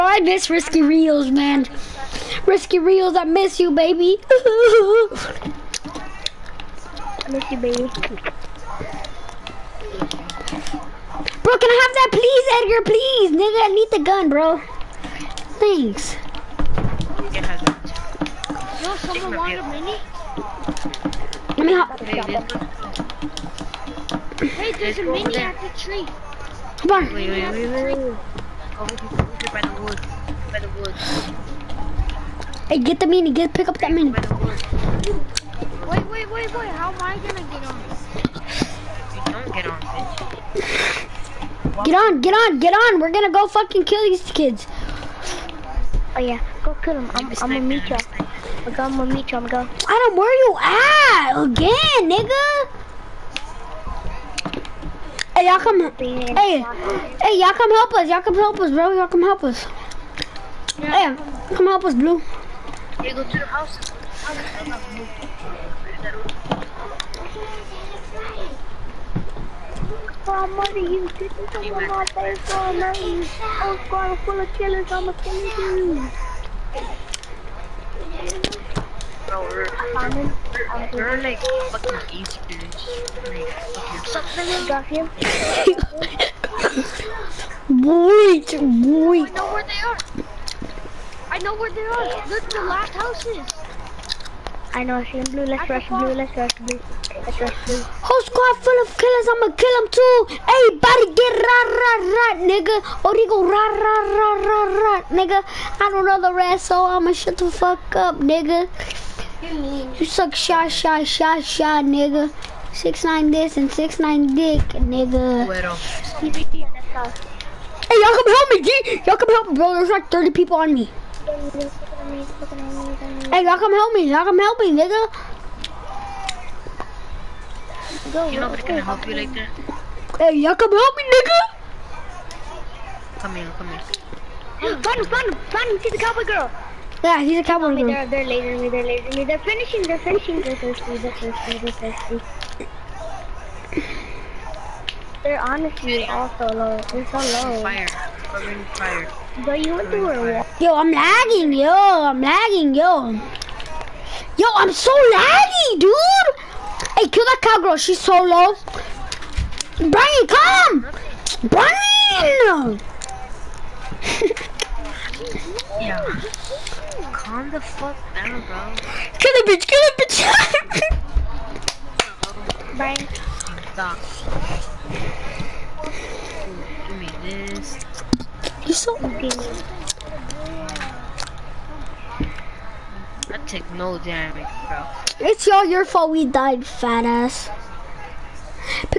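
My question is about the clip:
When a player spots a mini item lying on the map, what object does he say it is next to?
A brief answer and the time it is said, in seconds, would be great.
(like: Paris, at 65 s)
the tree, at 25 s.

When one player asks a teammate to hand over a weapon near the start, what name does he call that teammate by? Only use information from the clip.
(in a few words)
Edgar.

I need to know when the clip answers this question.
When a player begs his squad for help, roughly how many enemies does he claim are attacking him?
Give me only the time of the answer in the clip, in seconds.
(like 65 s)
120 s.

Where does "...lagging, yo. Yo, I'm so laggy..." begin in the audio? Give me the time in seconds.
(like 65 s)
152 s.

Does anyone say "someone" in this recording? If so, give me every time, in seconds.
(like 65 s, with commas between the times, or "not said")
18 s.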